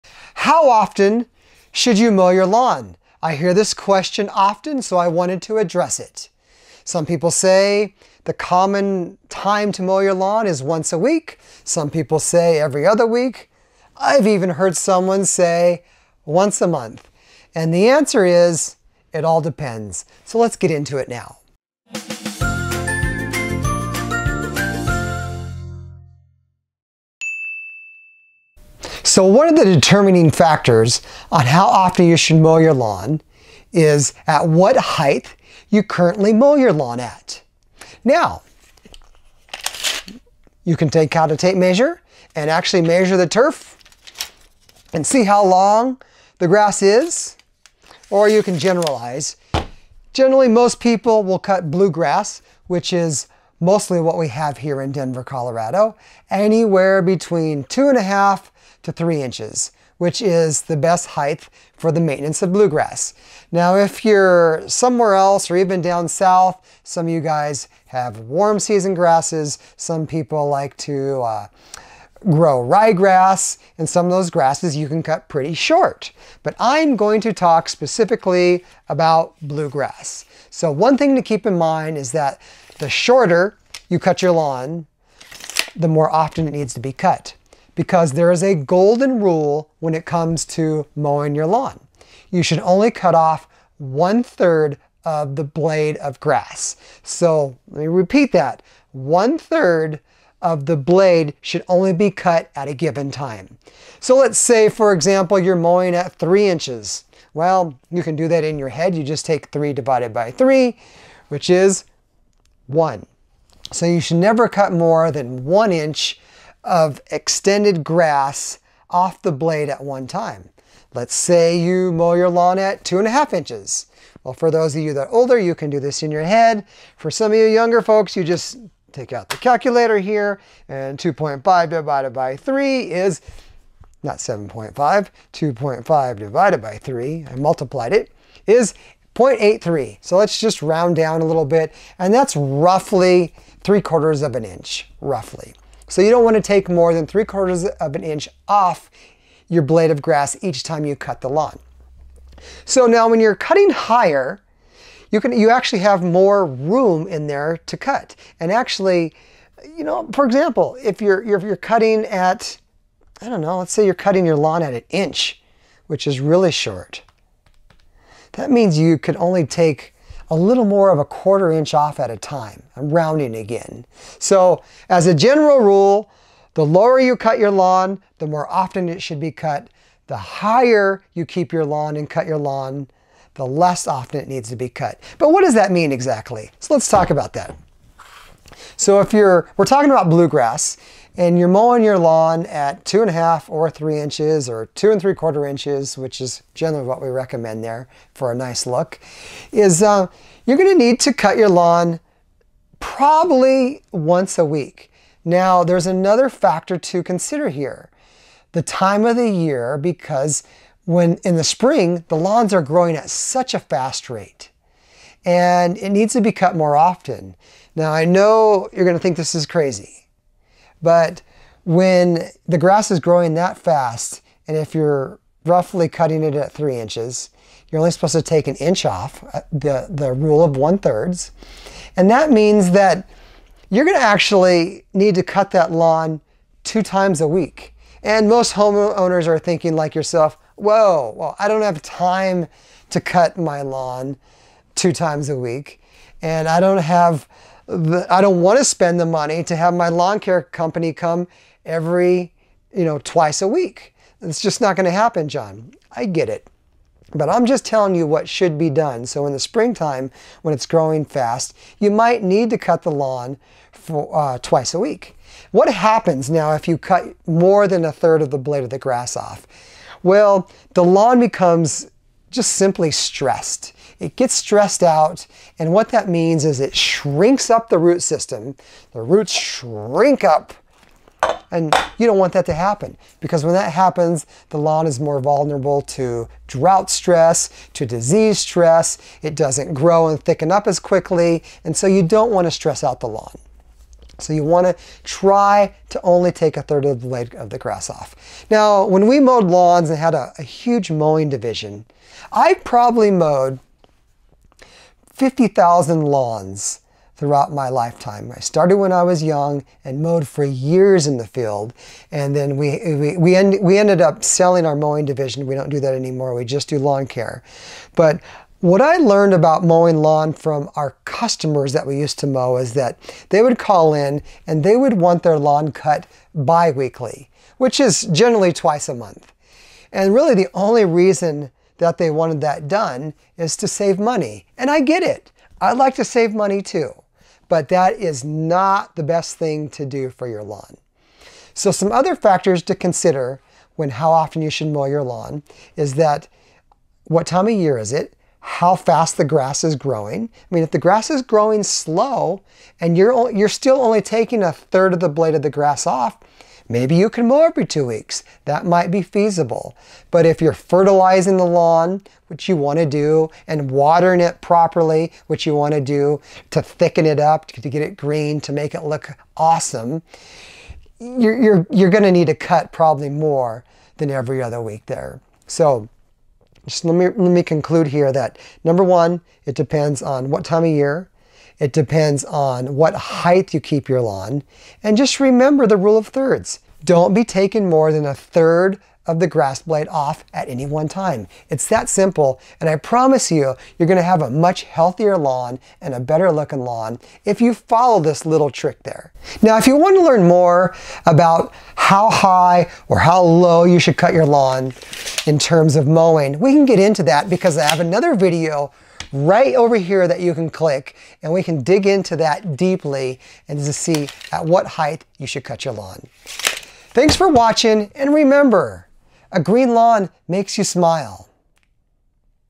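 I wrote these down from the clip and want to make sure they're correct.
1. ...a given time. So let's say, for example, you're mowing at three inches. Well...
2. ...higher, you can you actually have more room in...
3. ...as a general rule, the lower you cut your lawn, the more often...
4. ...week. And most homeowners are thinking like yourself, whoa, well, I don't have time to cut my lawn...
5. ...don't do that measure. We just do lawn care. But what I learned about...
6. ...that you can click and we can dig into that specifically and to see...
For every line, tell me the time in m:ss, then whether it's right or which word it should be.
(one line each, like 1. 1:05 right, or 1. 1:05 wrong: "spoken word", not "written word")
1. 1:42 right
2. 2:33 right
3. 2:54 right
4. 3:57 right
5. 5:15 wrong: "anymore", not "measure"
6. 6:50 wrong: "deeply", not "specifically".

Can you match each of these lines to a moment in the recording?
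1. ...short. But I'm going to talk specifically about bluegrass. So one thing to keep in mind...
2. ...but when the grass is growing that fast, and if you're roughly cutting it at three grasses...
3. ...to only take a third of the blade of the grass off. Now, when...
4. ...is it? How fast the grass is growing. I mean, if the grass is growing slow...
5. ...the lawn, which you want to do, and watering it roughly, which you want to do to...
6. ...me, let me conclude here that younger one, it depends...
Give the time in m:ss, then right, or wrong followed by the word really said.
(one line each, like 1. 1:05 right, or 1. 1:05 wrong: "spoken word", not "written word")
1. 1:15 right
2. 3:40 wrong: "inches", not "grasses"
3. 4:55 right
4. 5:47 right
5. 6:01 wrong: "properly", not "roughly"
6. 6:16 wrong: "number", not "younger".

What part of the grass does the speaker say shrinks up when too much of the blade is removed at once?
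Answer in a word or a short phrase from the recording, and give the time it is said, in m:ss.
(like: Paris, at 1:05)
root system, at 4:37.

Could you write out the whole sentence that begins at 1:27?
Because there is a golden rule when it comes to mowing your lawn.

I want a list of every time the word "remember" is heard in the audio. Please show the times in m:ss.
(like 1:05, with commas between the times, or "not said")
6:25, 6:58.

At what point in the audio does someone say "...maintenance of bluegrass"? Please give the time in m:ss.
1:02.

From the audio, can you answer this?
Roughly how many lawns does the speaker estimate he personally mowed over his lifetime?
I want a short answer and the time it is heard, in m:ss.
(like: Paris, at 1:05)
50,000, at 5:05.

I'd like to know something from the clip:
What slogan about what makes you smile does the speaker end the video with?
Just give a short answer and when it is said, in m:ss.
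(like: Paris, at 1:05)
a green lawn, at 6:59.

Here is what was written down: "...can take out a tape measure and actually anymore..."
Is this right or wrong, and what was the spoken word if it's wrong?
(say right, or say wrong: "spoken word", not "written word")
wrong: "measure", not "anymore".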